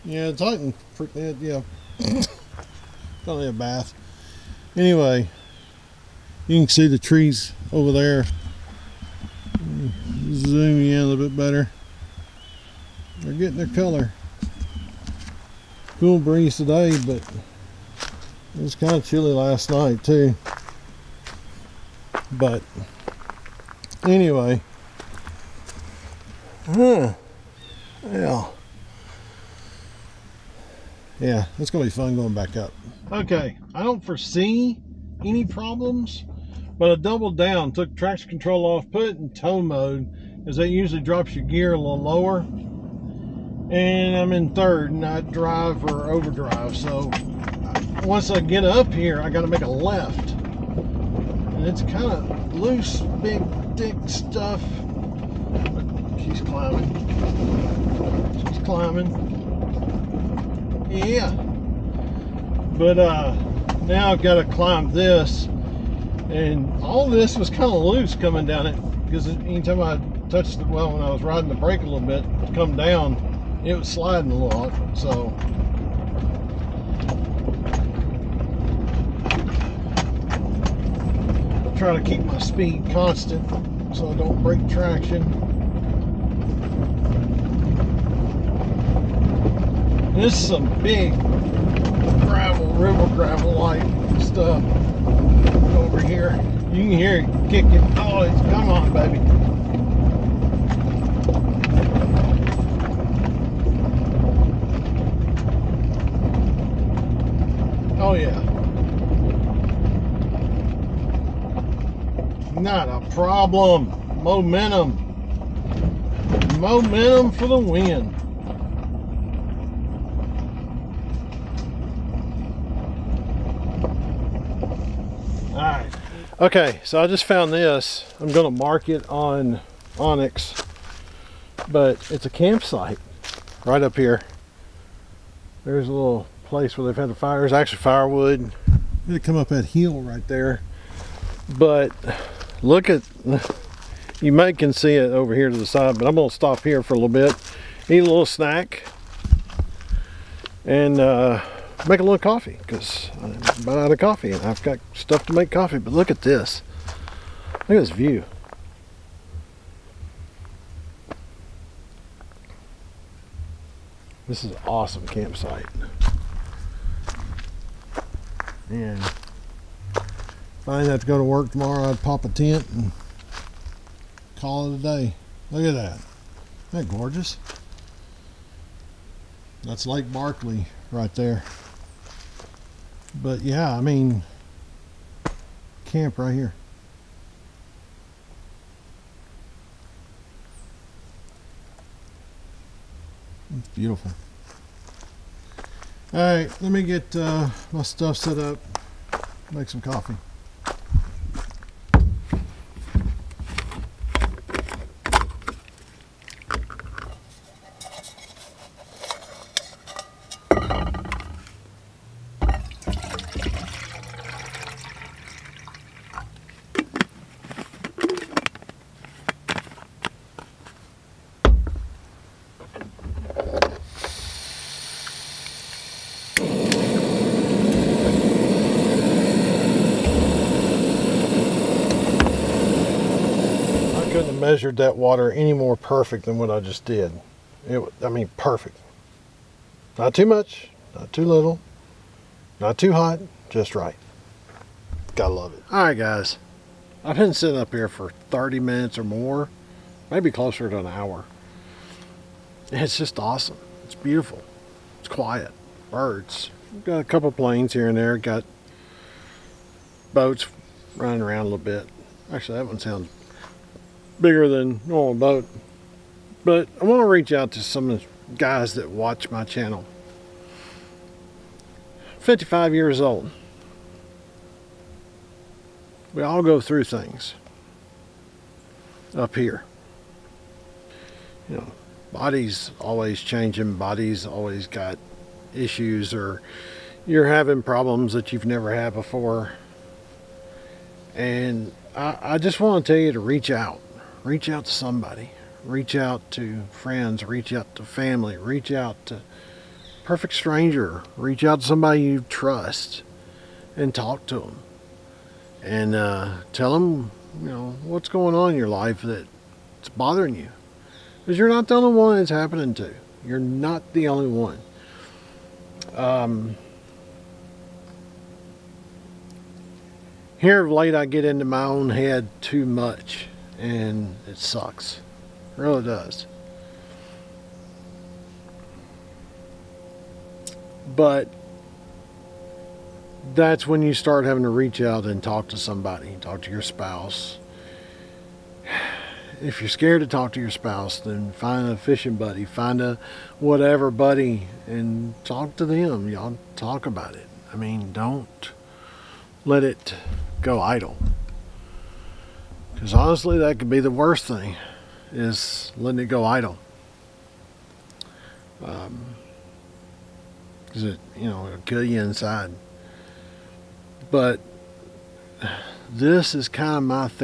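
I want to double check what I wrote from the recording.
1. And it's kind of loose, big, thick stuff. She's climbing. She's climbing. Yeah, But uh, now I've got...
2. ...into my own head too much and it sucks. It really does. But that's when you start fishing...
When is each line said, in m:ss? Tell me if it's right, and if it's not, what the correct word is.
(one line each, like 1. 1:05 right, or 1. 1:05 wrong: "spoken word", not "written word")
1. 0:51 right
2. 5:21 wrong: "having", not "fishing".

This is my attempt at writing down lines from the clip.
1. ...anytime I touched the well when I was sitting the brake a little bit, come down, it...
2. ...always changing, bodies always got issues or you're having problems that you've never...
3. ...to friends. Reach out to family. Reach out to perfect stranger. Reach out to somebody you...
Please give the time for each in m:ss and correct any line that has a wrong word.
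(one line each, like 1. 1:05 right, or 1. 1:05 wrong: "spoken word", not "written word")
1. 1:09 wrong: "riding", not "sitting"
2. 4:42 right
3. 4:56 right.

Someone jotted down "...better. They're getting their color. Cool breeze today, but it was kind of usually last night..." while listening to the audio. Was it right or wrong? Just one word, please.
wrong.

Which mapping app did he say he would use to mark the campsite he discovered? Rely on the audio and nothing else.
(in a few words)
onX.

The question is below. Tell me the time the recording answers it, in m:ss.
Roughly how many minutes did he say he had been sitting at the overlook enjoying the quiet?
4:08.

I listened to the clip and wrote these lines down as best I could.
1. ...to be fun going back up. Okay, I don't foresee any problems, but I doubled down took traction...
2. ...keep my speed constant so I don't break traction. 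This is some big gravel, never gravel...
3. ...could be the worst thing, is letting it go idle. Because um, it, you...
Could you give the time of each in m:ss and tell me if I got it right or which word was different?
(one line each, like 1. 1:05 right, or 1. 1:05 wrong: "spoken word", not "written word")
1. 0:31 right
2. 1:22 wrong: "river", not "never"
3. 5:53 right.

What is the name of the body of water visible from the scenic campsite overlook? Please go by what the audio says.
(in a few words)
Lake Barkley.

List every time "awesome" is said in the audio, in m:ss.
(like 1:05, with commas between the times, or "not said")
2:44, 4:13.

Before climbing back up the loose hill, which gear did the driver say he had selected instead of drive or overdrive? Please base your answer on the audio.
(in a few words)
Third.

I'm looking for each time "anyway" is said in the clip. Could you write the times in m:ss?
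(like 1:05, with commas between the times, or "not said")
0:04, 0:24.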